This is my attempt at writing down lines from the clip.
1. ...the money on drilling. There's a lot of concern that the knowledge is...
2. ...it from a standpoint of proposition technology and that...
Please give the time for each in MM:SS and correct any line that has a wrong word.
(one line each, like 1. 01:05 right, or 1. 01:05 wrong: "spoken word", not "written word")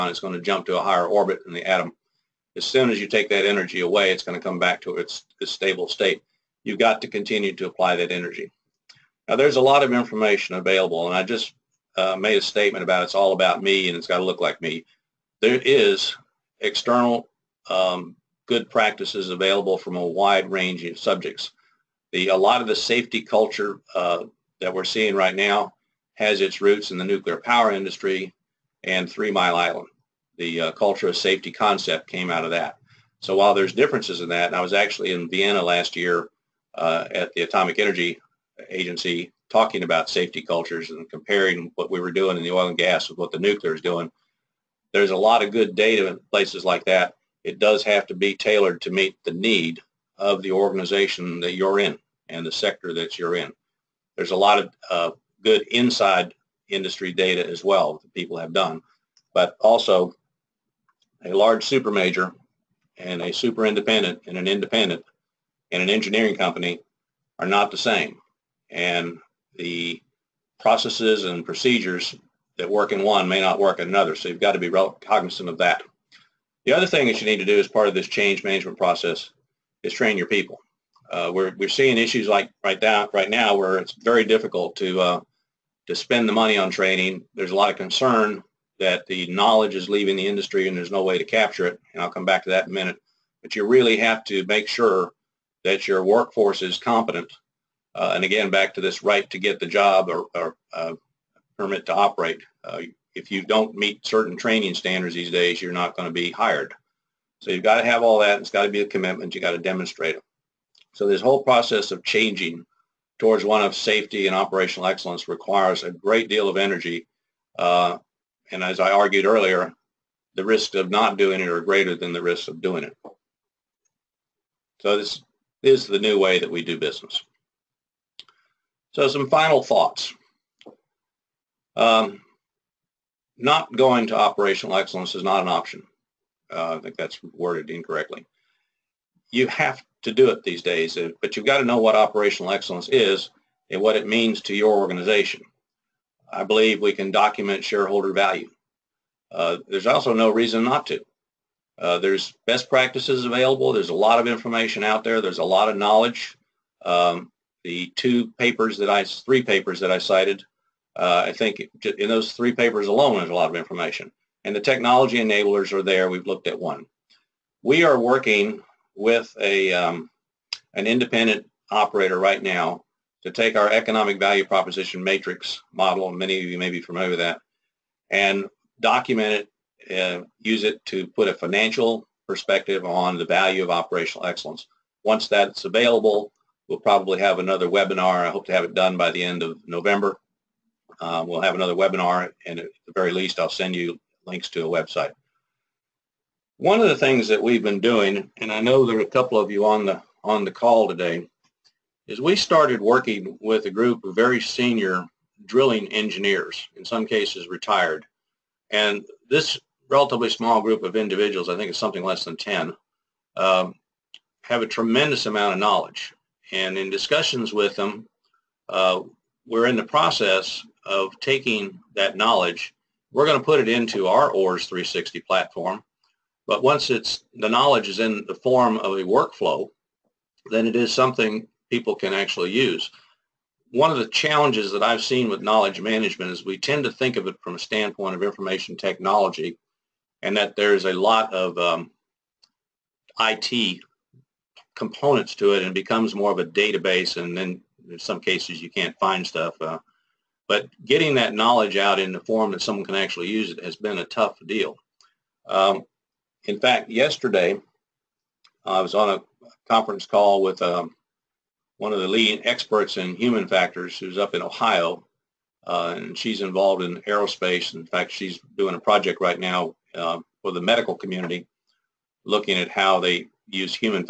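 1. 01:26 wrong: "training", not "drilling"
2. 03:57 wrong: "information", not "proposition".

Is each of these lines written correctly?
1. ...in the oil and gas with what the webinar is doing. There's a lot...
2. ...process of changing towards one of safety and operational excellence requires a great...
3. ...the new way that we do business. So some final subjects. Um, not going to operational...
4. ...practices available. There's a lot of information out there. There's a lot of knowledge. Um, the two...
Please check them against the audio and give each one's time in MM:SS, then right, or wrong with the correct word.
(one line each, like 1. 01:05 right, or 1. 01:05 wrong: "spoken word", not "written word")
1. 00:42 wrong: "nuclear", not "webinar"
2. 01:51 right
3. 02:05 wrong: "thoughts", not "subjects"
4. 02:32 right.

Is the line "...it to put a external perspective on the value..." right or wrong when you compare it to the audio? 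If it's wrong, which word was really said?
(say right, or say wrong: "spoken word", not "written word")
wrong: "financial", not "external".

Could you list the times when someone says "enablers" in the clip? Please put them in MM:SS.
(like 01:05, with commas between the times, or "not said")
02:45.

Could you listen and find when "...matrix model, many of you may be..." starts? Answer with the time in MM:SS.
02:55.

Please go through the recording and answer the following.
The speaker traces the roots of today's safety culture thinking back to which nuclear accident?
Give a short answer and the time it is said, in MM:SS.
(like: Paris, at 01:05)
Three Mile Island, at 00:29.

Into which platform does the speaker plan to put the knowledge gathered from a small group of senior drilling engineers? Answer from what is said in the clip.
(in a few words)
OARS 360.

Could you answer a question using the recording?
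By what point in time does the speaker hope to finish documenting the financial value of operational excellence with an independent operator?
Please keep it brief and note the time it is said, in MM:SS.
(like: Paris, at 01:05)
End of November, at 03:09.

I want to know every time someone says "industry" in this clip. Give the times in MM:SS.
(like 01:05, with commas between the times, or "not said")
00:27, 00:56, 01:30.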